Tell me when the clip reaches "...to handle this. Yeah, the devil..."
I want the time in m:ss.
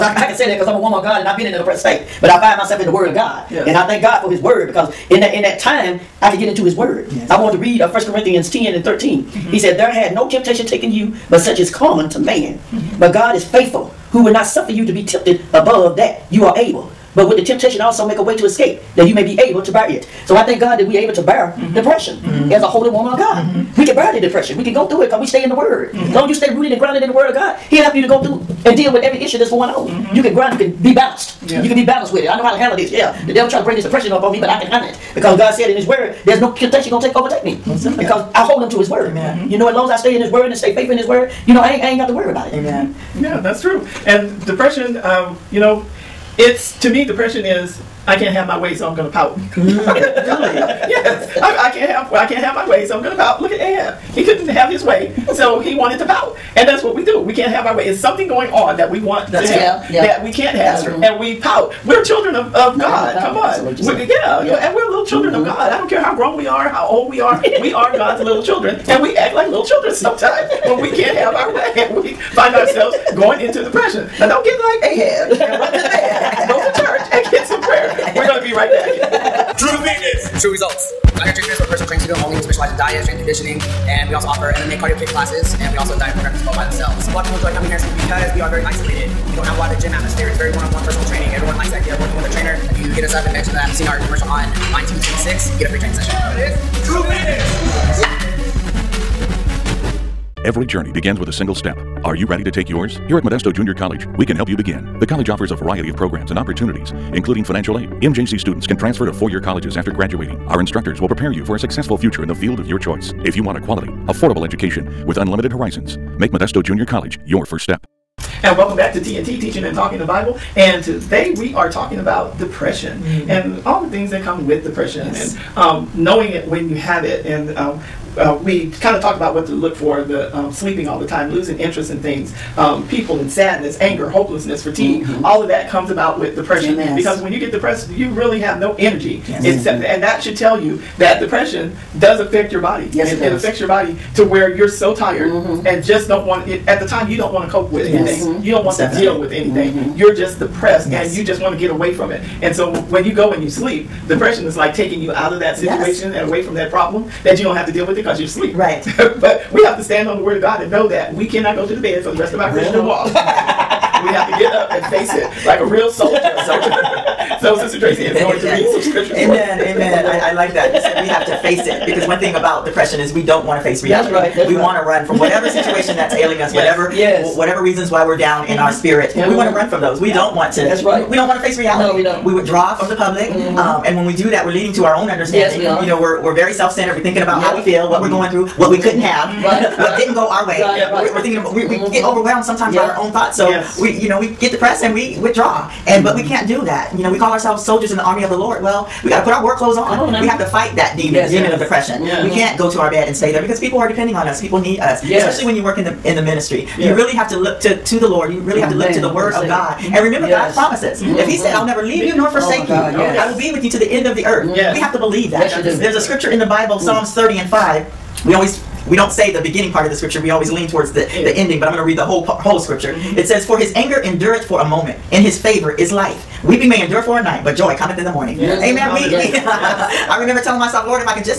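0:32.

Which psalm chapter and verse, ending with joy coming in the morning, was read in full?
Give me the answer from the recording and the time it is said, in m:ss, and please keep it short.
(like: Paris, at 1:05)
Psalms 30:5, at 3:36.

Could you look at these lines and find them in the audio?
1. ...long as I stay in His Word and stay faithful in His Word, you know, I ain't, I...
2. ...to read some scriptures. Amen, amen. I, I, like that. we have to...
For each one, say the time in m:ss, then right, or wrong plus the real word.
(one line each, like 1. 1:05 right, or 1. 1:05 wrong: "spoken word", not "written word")
1. 0:39 right
2. 2:48 right.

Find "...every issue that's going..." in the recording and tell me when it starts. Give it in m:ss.
0:29.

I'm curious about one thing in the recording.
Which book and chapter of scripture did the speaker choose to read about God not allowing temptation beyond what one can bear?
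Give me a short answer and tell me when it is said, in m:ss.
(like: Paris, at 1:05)
First Corinthians 10, at 0:07.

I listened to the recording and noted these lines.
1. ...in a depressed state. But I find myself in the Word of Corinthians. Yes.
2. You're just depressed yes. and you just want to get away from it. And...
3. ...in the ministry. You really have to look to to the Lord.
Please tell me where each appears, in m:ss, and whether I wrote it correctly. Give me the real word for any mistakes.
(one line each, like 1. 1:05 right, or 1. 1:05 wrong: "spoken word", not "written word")
1. 0:01 wrong: "God", not "Corinthians"
2. 2:29 right
3. 3:26 right.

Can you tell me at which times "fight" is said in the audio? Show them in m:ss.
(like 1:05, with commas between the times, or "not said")
3:20.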